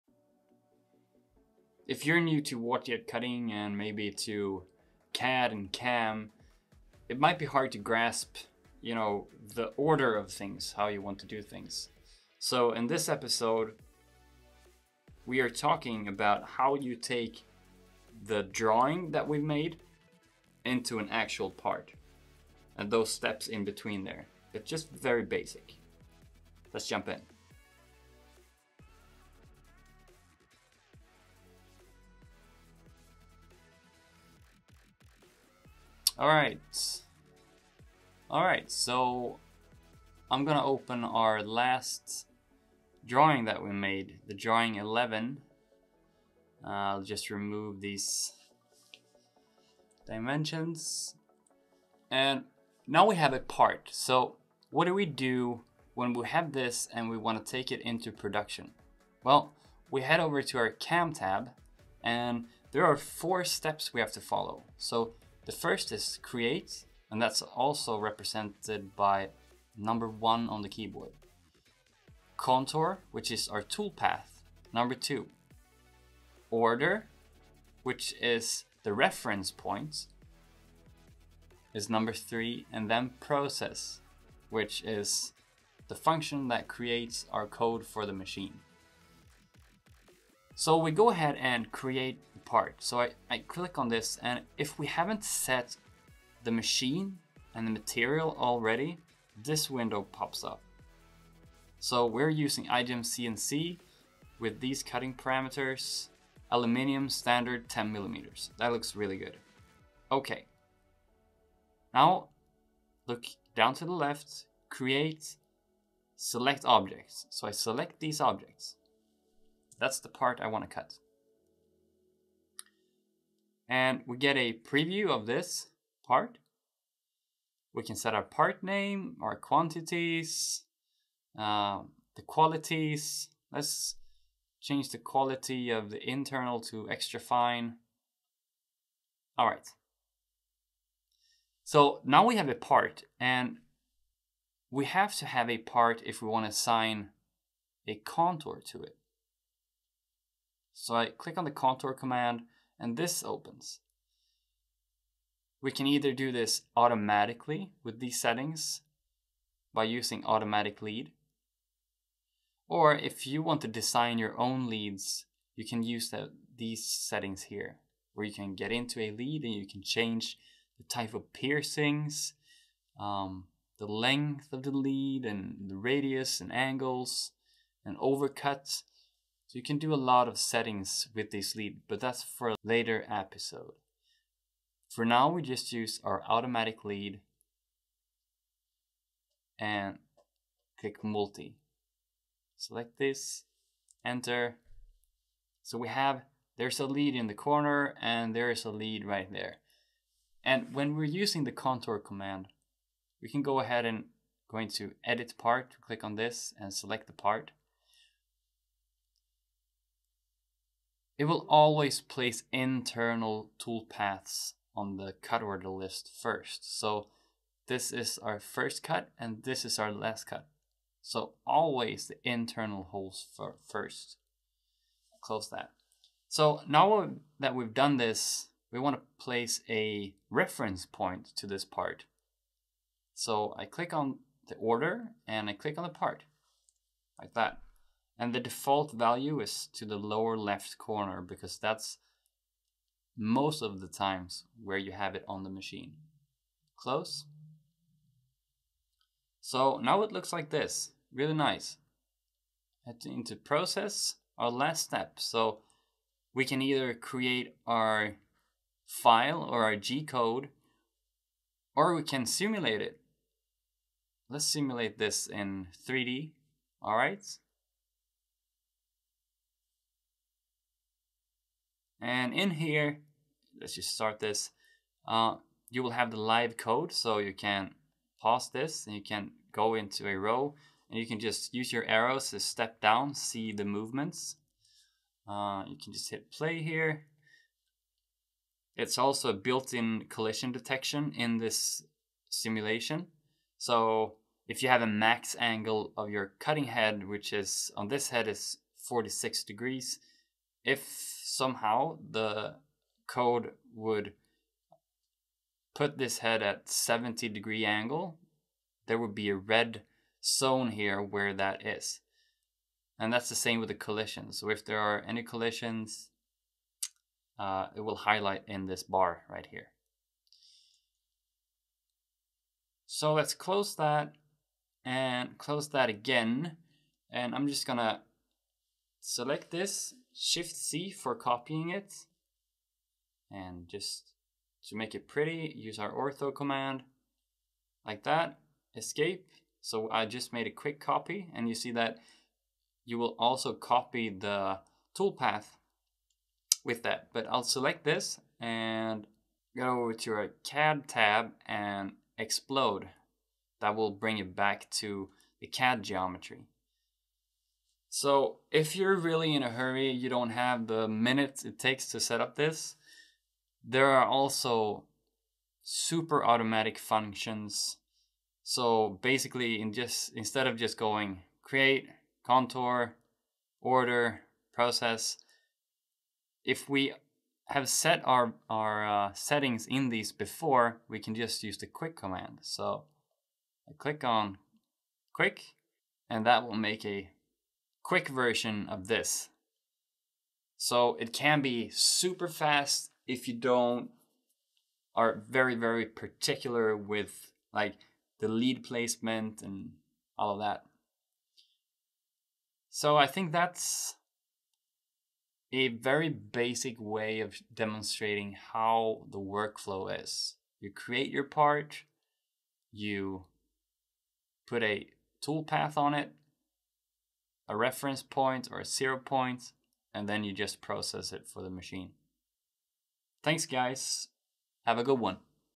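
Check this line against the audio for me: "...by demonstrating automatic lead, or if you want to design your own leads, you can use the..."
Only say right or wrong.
wrong.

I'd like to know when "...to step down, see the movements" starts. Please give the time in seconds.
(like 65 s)
282 s.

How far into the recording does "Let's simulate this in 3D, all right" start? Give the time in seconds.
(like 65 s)
264 s.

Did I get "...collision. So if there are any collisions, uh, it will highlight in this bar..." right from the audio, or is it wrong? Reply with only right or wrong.
right.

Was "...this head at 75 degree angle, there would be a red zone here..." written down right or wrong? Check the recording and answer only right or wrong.
wrong.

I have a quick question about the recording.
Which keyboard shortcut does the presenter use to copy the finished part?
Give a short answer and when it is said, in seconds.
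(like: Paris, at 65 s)
Shift C, at 330 s.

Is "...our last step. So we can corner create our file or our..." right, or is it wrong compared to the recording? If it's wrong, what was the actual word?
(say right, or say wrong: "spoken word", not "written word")
wrong: "either", not "corner".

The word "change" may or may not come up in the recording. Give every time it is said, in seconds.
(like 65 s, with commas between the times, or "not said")
134 s, 169 s.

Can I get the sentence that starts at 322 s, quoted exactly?
So let's close that and close that again.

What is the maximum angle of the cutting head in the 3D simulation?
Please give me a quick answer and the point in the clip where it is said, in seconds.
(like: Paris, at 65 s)
46 degrees, at 298 s.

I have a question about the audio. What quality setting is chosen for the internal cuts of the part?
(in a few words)
Extra fine.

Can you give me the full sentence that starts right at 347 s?
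But I'll select this and go over to our CAD tab and explode.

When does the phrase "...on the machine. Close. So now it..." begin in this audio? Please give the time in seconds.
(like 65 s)
245 s.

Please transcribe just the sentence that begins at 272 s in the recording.
And in here, let's just start this.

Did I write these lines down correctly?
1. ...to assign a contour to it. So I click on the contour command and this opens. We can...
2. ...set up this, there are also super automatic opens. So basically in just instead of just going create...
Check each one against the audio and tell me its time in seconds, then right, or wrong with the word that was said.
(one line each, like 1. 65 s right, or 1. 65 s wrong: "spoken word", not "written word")
1. 146 s right
2. 361 s wrong: "functions", not "opens".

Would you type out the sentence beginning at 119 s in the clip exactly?
That's the part I want to cut and we get a preview of this part.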